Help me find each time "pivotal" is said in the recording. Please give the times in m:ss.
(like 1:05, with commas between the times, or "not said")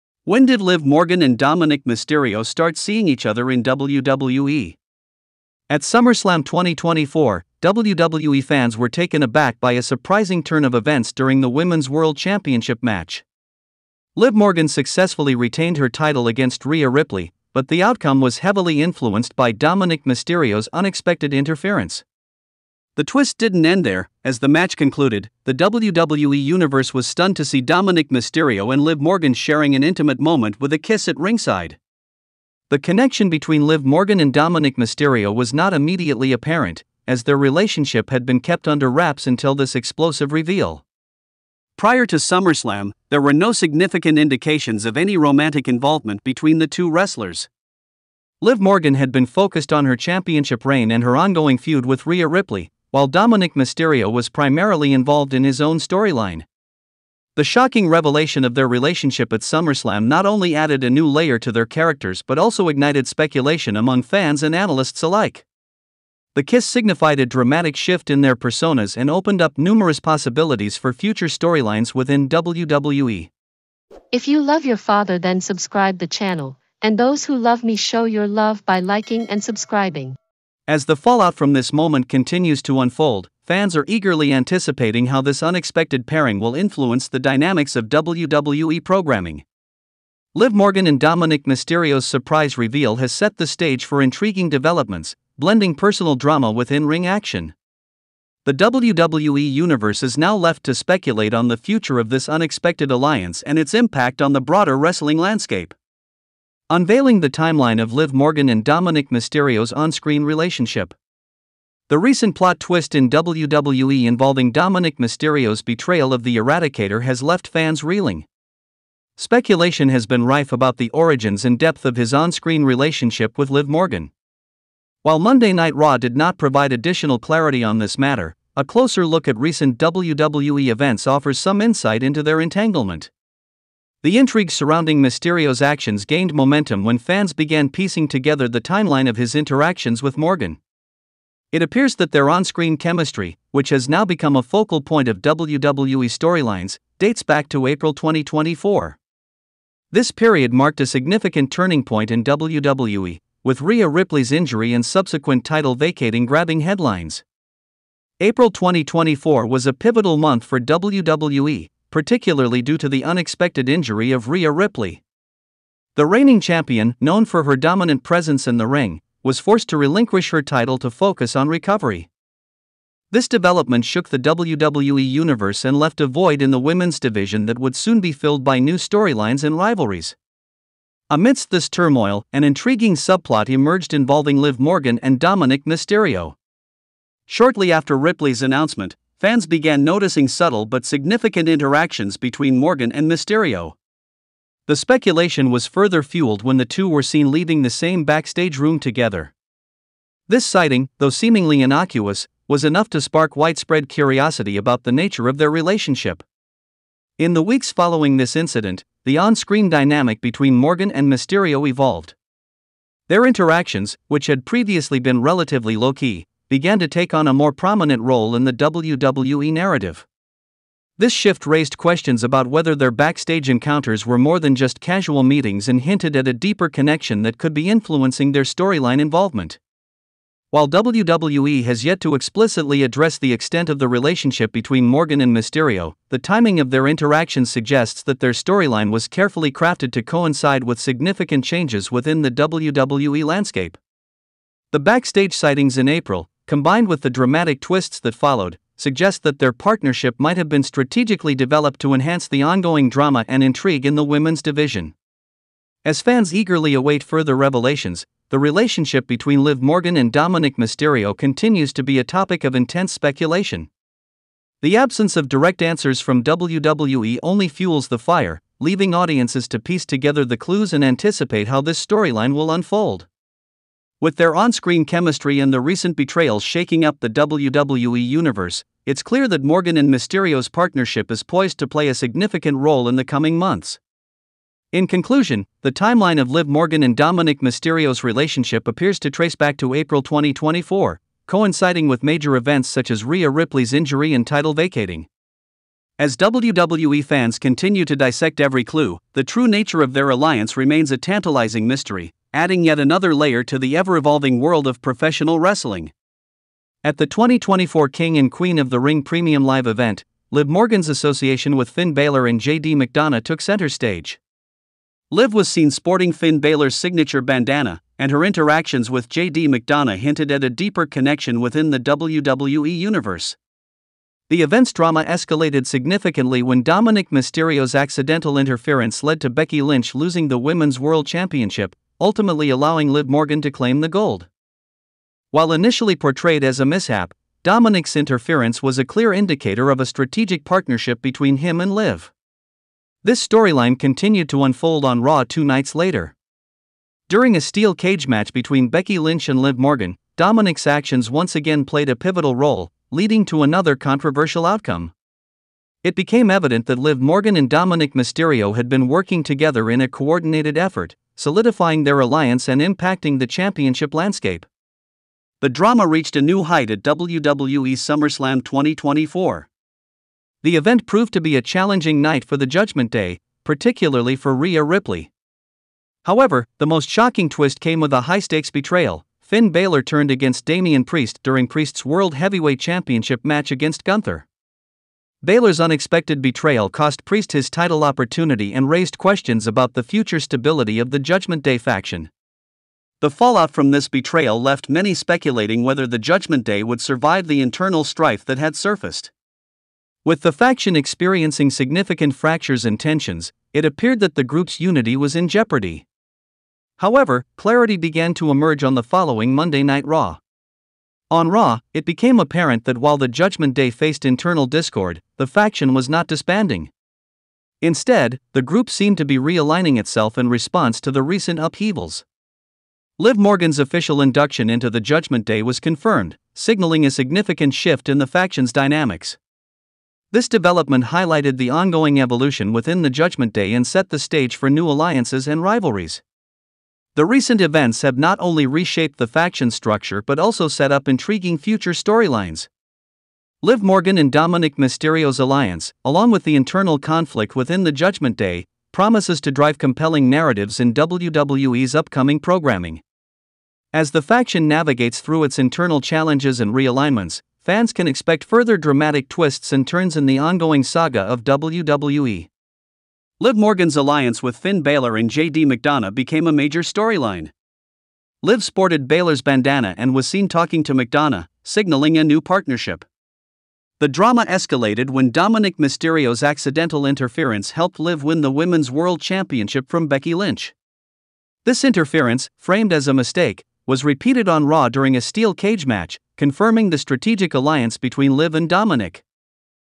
2:39, 5:51.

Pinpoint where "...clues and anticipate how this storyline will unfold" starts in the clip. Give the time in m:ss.
4:30.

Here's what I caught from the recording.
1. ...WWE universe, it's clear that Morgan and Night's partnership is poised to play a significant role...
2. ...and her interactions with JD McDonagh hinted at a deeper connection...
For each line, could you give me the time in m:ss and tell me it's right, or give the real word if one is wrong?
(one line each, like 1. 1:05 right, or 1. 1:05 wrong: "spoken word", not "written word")
1. 4:37 wrong: "Mysterio", not "Night"
2. 5:17 right.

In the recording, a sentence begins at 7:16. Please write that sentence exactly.
The recent events have not only reshaped the faction structure but also set up intriguing future storylines.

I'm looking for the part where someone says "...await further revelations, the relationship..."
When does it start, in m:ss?
4:16.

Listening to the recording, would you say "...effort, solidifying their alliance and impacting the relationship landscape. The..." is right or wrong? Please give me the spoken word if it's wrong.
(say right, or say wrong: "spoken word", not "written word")
wrong: "championship", not "relationship".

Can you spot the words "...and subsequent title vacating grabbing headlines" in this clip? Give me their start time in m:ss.
2:34.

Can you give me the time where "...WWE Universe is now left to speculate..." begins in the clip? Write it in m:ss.
1:38.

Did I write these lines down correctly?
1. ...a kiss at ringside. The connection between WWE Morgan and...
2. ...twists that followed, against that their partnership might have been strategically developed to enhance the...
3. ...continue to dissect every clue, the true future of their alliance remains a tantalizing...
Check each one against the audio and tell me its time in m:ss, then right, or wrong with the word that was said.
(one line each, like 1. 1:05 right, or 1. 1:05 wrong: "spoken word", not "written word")
1. 0:30 wrong: "Liv", not "WWE"
2. 4:07 wrong: "suggest", not "against"
3. 4:57 wrong: "nature", not "future".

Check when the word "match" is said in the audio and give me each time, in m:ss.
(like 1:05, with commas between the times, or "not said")
0:12, 0:24, 5:48, 6:23, 8:05.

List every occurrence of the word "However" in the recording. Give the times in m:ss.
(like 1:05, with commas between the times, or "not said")
6:16, 6:46.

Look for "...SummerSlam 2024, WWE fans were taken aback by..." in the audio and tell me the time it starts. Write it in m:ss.
0:05.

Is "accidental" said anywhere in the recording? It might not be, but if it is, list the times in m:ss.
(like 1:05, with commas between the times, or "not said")
5:27, 7:56.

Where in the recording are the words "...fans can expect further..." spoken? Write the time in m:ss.
7:37.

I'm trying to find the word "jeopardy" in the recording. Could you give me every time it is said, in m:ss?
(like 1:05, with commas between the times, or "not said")
6:45.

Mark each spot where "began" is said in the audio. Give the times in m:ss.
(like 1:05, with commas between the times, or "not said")
2:17, 3:09, 3:36, 6:47.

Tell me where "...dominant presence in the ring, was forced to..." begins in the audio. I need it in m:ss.
2:47.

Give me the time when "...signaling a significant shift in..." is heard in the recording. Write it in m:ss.
7:06.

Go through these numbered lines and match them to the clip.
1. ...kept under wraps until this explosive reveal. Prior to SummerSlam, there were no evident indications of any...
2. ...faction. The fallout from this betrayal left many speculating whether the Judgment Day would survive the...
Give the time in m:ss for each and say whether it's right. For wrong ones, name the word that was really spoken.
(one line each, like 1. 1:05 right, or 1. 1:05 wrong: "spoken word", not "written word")
1. 0:38 wrong: "significant", not "evident"
2. 6:31 right.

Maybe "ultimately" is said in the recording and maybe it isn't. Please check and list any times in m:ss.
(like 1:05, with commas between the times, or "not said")
5:32.